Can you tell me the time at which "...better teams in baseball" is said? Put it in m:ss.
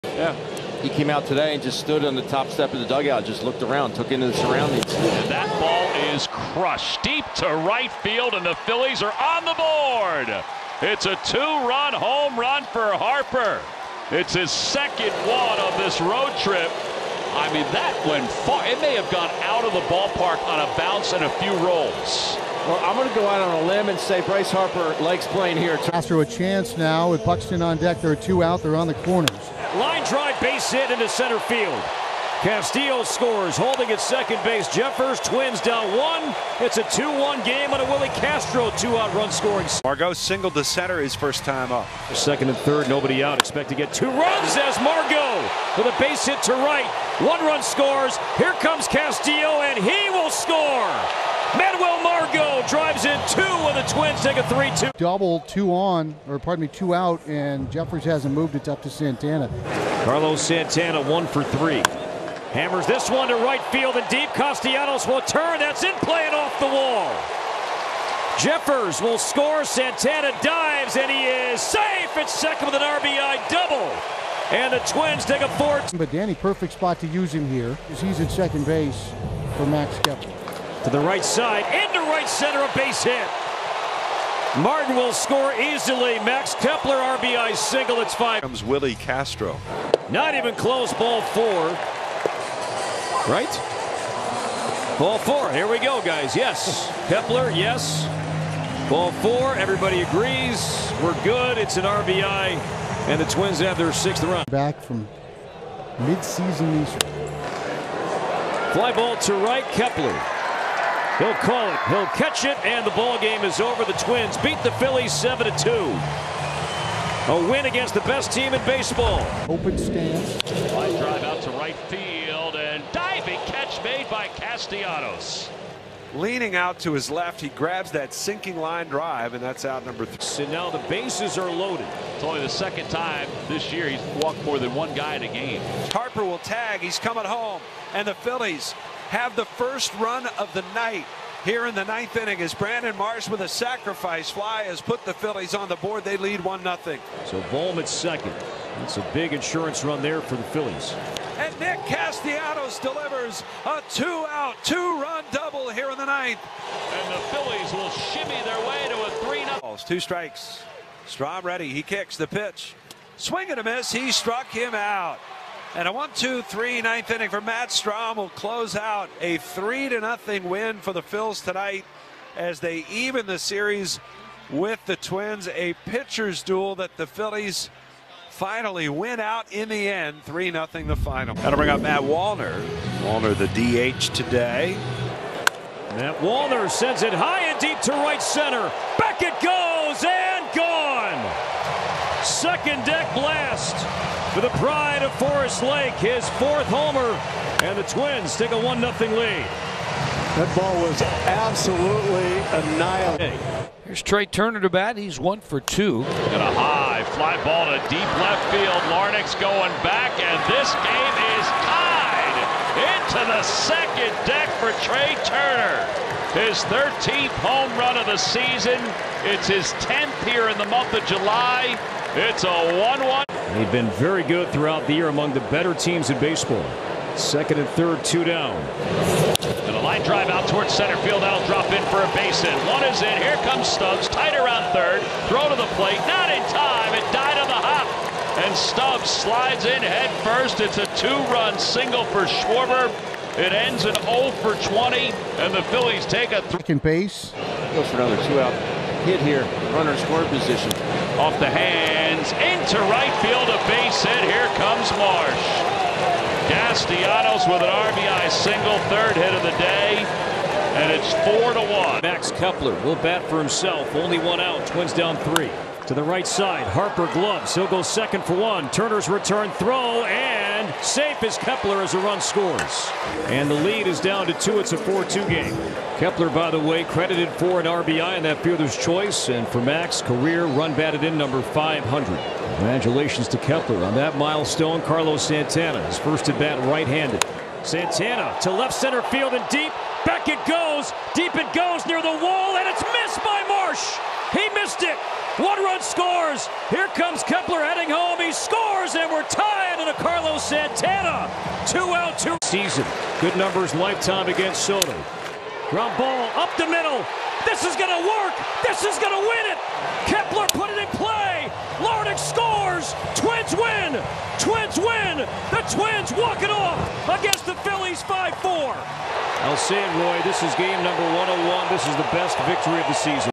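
3:45.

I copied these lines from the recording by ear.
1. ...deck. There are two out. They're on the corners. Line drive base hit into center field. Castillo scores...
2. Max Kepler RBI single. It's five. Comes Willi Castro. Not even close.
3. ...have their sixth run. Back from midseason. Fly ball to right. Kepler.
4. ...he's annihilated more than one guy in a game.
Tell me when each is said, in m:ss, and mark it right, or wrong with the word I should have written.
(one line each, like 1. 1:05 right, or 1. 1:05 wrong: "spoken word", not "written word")
1. 0:27 right
2. 1:26 right
3. 1:43 right
4. 2:13 wrong: "walked", not "annihilated".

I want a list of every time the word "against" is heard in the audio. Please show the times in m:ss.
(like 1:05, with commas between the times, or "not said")
1:57, 5:04, 5:17.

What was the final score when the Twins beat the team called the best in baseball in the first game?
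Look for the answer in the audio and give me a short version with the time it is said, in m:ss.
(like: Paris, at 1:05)
7-2, at 1:55.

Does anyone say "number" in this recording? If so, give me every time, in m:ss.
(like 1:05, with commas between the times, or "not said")
2:09, 4:41, 5:03, 5:20.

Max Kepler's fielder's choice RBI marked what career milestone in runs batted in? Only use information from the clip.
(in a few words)
500.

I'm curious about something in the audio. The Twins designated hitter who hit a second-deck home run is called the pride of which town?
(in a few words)
Forest Lake.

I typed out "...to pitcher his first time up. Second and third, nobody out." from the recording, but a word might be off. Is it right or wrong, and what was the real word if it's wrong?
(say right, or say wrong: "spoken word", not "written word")
wrong: "center", not "pitcher".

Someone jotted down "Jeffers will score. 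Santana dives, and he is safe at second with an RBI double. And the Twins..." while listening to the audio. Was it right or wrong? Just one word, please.
right.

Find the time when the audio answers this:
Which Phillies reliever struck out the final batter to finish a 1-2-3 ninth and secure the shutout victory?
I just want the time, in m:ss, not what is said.
2:47.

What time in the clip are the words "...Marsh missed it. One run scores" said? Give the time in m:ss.
4:53.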